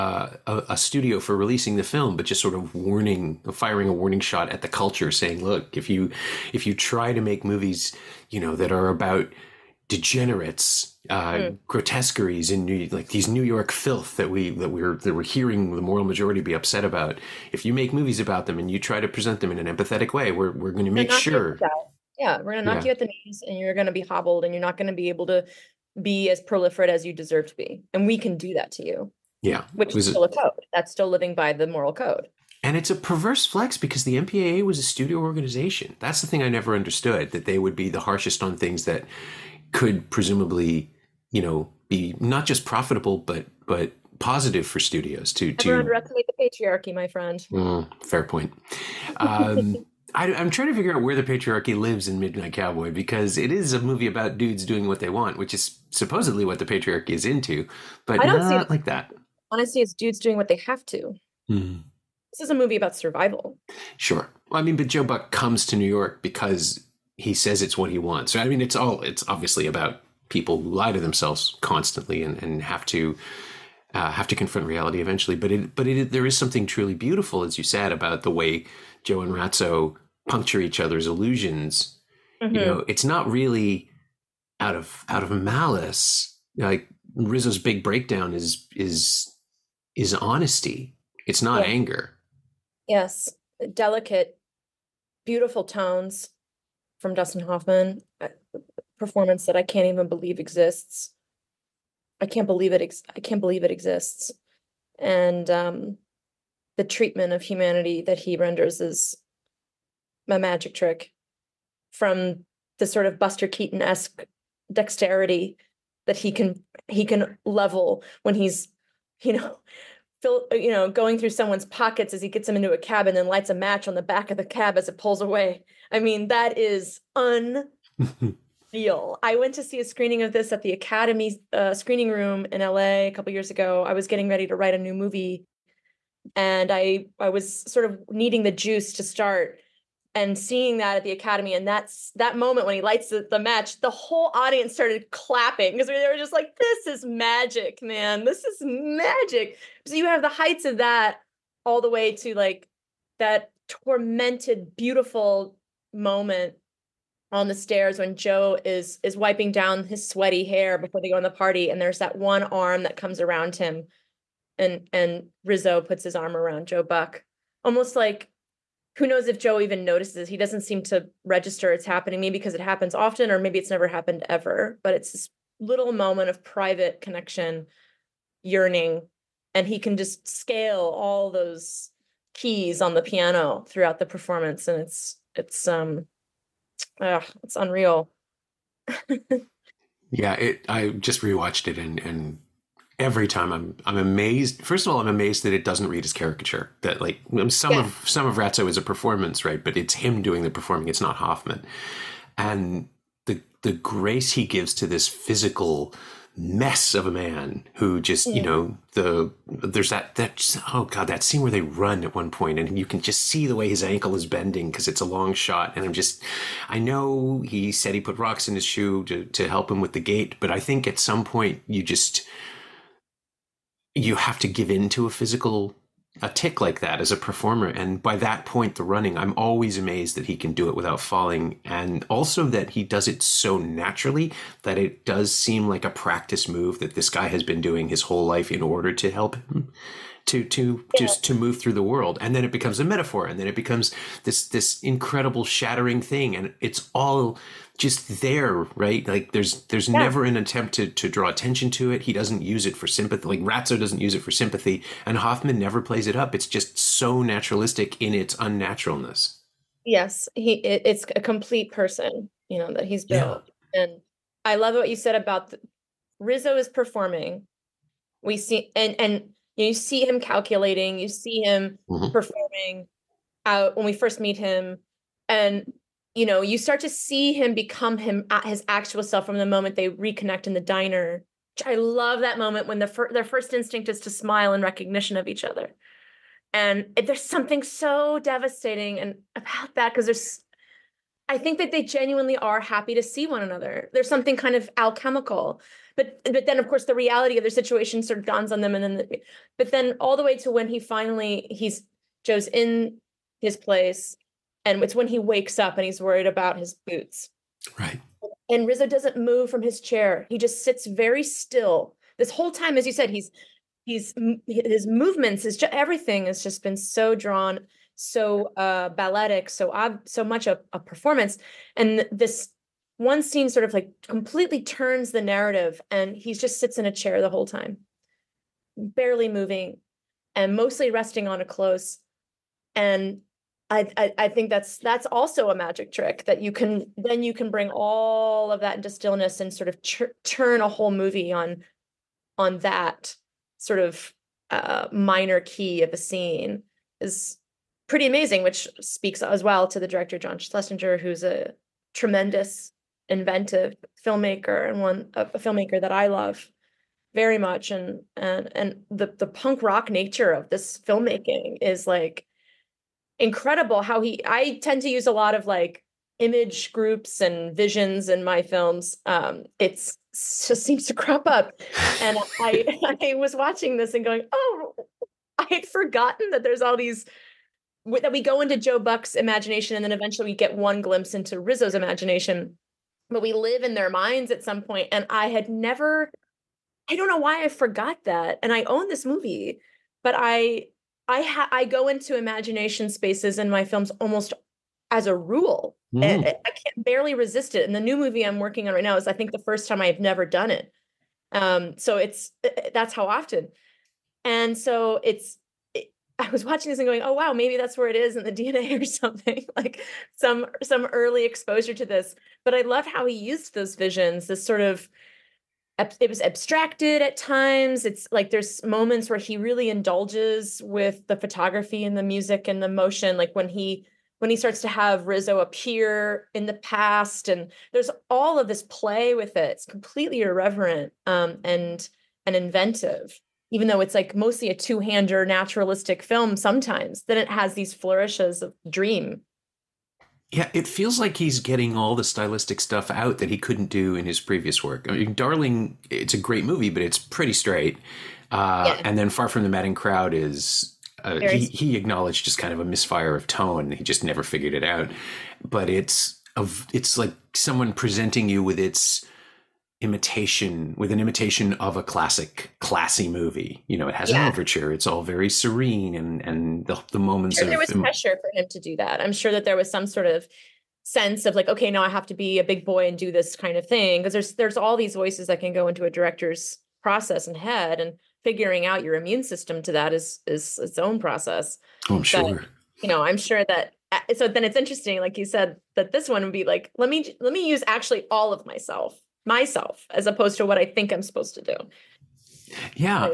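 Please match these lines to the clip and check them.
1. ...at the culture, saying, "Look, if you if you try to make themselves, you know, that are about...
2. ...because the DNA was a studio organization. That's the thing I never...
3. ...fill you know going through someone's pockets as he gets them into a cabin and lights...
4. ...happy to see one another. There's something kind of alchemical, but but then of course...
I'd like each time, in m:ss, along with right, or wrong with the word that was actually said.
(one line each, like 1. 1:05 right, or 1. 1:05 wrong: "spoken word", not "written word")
1. 0:04 wrong: "movies", not "themselves"
2. 0:33 wrong: "MPAA", not "DNA"
3. 2:00 right
4. 4:52 right.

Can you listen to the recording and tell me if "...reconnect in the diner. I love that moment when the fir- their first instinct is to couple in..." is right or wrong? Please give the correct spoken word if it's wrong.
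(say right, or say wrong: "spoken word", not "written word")
wrong: "smile", not "couple".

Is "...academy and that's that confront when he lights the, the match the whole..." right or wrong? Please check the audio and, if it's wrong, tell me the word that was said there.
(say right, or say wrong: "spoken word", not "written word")
wrong: "moment", not "confront".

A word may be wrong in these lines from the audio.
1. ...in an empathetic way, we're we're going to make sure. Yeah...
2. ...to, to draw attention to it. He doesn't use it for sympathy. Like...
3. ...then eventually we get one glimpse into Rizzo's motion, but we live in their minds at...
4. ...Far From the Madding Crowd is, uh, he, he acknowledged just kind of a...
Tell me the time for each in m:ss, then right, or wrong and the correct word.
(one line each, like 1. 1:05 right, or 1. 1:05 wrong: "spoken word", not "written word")
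1. 0:19 right
2. 4:10 right
3. 6:19 wrong: "imagination", not "motion"
4. 7:29 right.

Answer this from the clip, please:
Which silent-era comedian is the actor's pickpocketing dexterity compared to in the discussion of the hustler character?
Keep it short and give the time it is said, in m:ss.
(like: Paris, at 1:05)
Buster Keaton, at 1:53.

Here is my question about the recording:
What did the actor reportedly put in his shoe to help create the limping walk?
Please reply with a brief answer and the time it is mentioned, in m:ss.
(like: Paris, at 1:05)
rocks, at 3:38.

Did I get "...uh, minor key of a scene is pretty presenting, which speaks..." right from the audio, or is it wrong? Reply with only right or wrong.
wrong.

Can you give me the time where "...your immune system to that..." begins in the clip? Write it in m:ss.
7:58.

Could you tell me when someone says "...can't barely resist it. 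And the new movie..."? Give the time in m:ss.
6:36.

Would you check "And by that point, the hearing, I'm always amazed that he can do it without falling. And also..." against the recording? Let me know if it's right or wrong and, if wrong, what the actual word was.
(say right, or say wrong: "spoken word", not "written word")
wrong: "running", not "hearing".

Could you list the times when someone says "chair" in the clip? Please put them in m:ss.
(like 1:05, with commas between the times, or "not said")
5:09, 5:26.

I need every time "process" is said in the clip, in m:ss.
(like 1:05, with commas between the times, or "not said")
7:56, 8:00.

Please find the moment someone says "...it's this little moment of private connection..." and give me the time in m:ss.
2:54.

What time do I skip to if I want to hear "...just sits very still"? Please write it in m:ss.
5:10.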